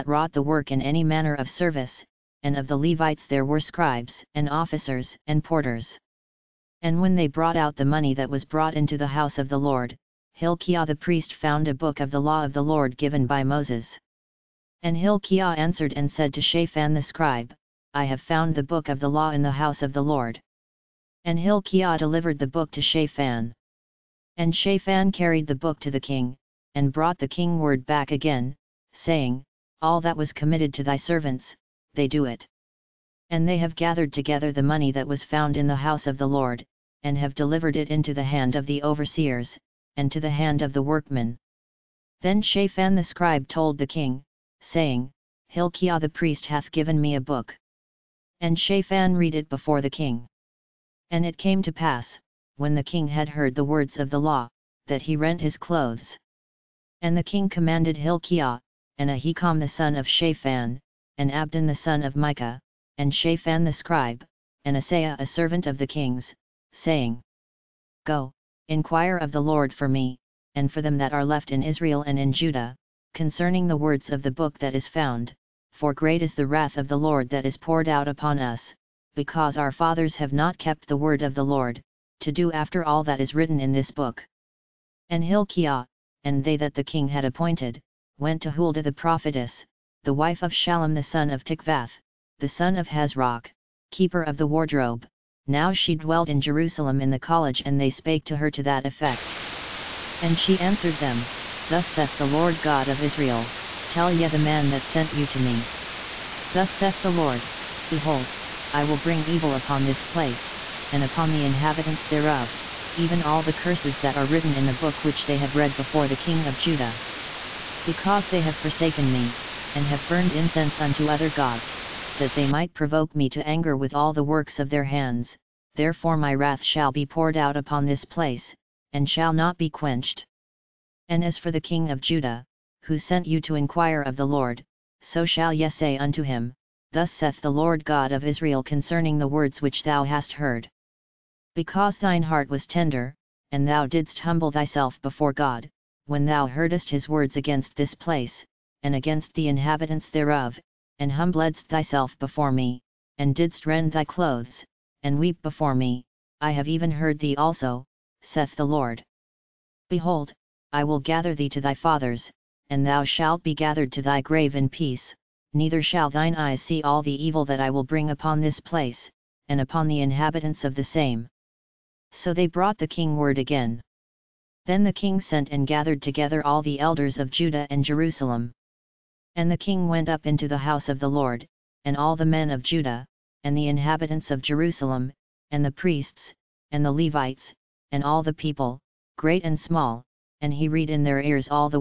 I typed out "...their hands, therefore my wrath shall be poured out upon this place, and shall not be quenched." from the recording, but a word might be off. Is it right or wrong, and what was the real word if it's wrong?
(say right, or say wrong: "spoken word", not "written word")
right.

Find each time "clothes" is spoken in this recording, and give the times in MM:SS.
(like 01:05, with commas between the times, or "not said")
00:55, 02:34.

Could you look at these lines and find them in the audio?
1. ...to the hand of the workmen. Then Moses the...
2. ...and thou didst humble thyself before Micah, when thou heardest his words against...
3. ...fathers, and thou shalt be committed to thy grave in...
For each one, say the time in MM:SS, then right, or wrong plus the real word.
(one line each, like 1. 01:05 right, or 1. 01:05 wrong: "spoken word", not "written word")
1. 00:40 wrong: "Shaphan", not "Moses"
2. 02:23 wrong: "God", not "Micah"
3. 02:41 wrong: "gathered", not "committed".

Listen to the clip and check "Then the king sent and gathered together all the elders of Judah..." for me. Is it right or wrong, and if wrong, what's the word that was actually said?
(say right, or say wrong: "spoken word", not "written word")
right.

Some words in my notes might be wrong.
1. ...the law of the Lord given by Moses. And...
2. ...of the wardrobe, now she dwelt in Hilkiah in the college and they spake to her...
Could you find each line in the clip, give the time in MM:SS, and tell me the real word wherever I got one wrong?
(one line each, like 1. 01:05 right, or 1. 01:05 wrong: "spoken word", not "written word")
1. 00:12 right
2. 01:34 wrong: "Jerusalem", not "Hilkiah".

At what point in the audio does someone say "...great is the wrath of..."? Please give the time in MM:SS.
01:15.